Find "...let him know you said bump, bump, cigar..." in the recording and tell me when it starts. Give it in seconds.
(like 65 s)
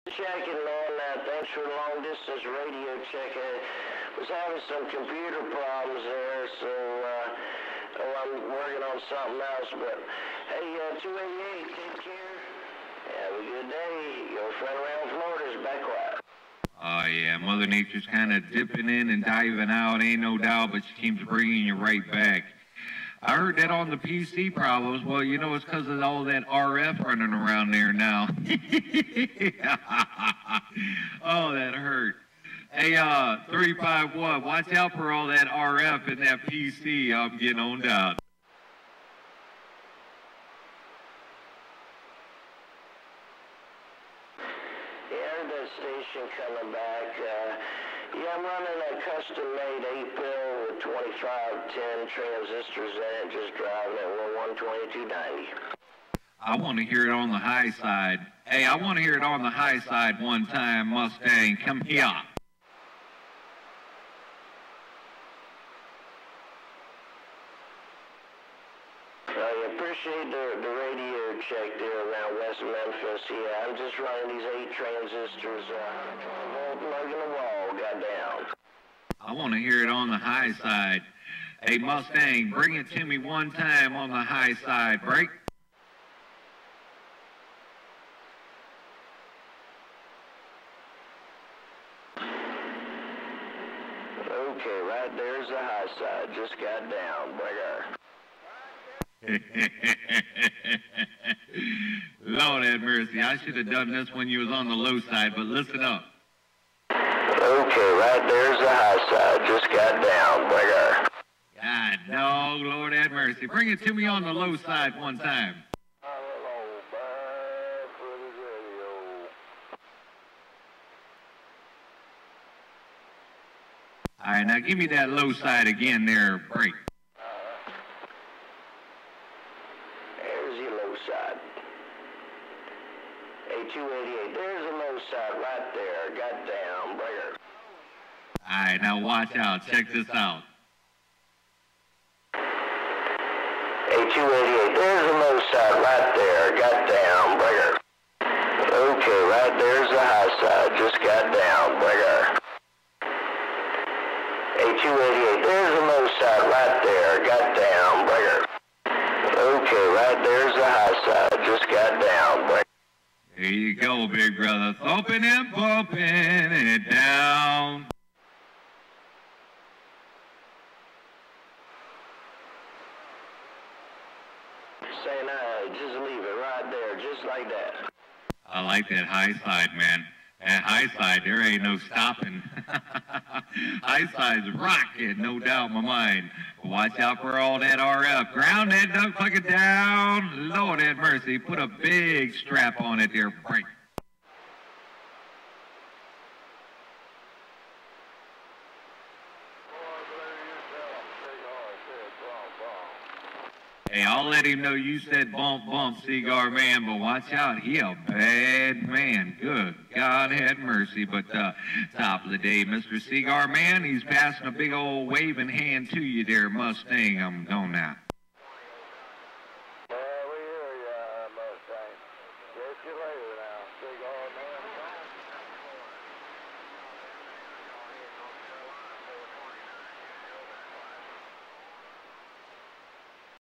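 204 s.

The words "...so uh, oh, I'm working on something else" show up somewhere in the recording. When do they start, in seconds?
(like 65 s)
6 s.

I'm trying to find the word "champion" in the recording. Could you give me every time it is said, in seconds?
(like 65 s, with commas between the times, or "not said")
not said.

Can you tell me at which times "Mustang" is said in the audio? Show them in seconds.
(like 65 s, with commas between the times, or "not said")
60 s, 81 s, 216 s.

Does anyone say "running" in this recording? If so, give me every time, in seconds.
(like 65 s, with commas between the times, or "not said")
27 s, 48 s, 73 s.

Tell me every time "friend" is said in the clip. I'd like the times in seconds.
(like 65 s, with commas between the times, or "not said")
14 s.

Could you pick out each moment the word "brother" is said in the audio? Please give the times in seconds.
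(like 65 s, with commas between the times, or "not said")
110 s, 164 s.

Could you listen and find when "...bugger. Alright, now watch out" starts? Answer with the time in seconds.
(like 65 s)
136 s.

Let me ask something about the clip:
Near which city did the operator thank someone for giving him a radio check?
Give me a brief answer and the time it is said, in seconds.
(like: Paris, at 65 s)
West Memphis, at 72 s.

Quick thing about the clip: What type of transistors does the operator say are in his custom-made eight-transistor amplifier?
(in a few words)
2510.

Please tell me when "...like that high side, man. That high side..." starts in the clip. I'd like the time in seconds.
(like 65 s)
178 s.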